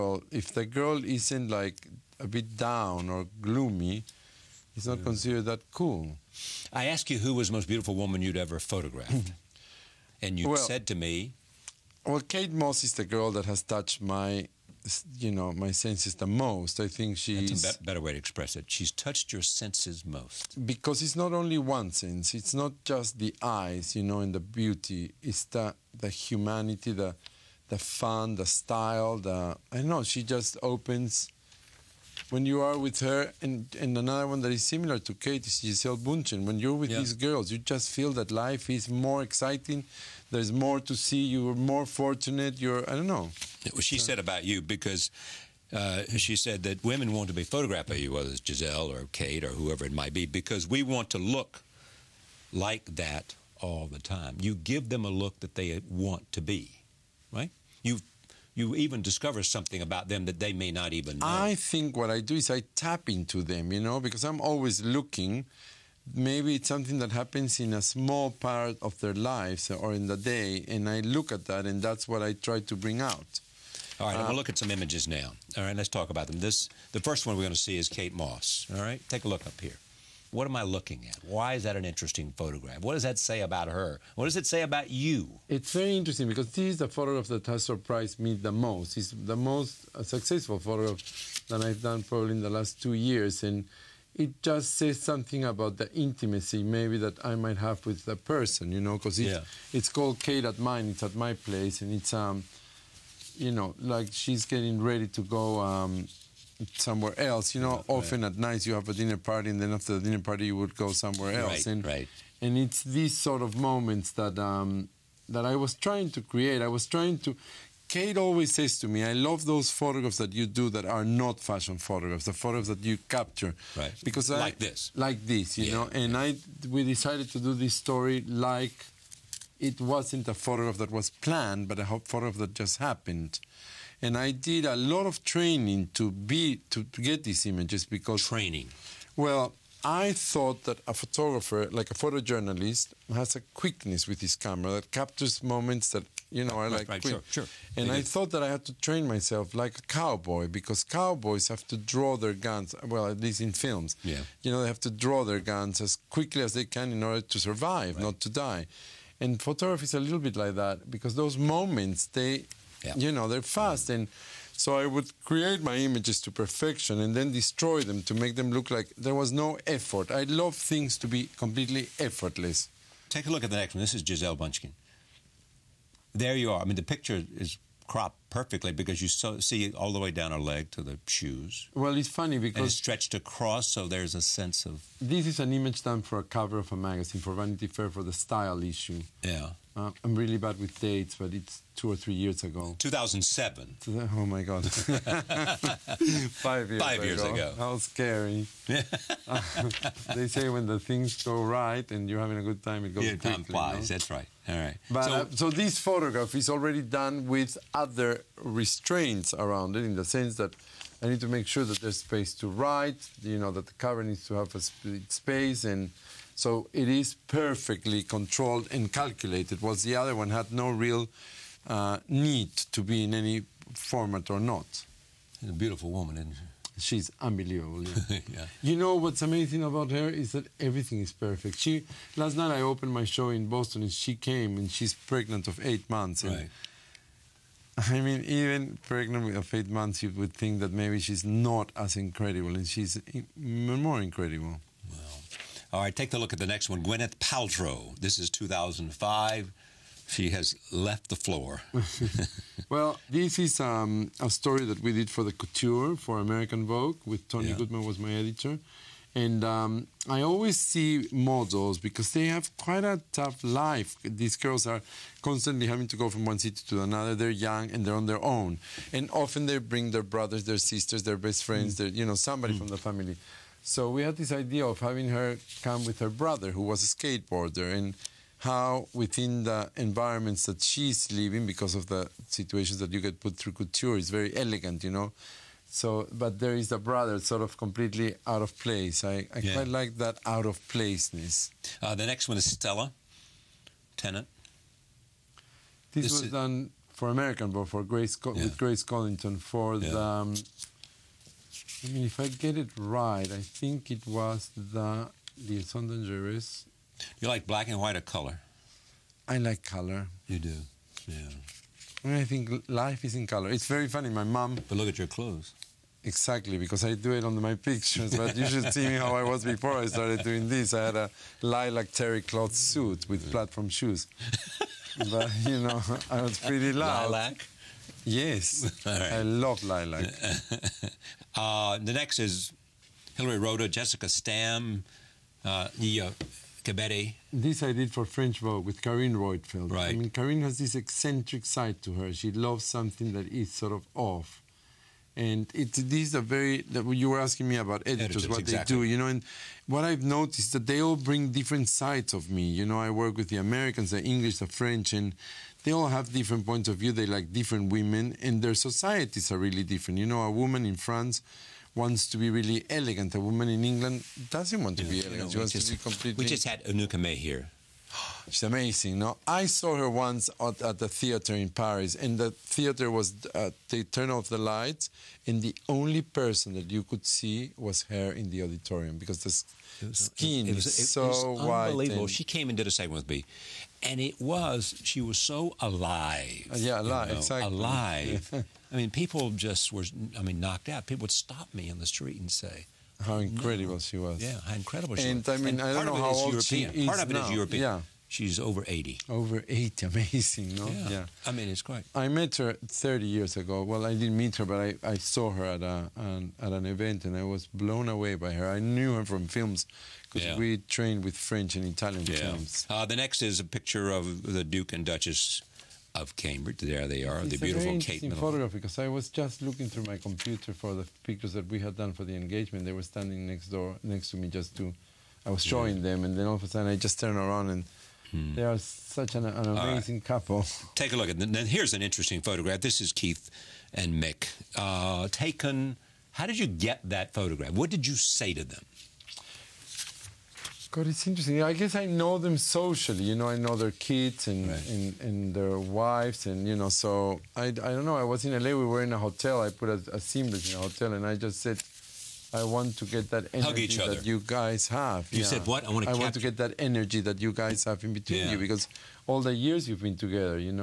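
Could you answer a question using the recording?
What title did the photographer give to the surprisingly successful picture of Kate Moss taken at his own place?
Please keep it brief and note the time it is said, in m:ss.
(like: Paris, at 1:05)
Kate at mine, at 1:40.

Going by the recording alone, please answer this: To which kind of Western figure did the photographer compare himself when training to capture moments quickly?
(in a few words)
Cowboy.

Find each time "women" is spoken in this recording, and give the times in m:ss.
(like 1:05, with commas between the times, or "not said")
0:46, 5:57.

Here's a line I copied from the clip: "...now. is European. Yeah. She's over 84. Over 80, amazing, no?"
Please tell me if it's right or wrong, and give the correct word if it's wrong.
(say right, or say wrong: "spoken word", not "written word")
wrong: "80", not "84".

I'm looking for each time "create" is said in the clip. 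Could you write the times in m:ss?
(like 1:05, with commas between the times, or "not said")
1:56, 2:45.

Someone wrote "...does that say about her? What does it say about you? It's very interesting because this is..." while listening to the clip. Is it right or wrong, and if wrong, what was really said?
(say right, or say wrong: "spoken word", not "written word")
right.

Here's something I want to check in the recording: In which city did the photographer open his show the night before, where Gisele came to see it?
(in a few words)
Boston.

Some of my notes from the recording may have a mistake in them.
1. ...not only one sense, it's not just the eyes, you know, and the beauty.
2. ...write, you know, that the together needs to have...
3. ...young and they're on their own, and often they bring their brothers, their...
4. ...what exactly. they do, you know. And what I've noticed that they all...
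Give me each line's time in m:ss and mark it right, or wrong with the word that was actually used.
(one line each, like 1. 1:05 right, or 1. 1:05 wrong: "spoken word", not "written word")
1. 0:21 right
2. 3:32 wrong: "cover", not "together"
3. 4:27 right
4. 5:48 right.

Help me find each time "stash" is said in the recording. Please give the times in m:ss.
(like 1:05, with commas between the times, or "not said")
not said.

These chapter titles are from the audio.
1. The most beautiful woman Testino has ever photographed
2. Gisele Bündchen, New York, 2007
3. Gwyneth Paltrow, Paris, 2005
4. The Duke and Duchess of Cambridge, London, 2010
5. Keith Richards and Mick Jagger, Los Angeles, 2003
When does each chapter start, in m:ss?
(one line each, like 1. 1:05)
1. 0:05
2. 2:52
3. 4:05
4. 6:52
5. 7:12.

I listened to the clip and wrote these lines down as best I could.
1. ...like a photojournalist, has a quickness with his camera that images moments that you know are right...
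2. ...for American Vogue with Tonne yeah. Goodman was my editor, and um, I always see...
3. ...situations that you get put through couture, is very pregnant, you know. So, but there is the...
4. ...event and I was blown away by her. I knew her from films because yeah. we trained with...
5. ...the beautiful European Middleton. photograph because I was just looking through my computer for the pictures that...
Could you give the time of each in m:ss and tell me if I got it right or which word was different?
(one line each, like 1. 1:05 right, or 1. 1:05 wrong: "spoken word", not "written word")
1. 2:21 wrong: "captures", not "images"
2. 4:15 right
3. 4:42 wrong: "elegant", not "pregnant"
4. 6:46 right
5. 6:57 wrong: "Kate", not "European".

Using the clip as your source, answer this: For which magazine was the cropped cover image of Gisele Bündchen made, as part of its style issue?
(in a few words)
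Vanity Fair.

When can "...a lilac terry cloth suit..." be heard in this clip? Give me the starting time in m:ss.
5:20.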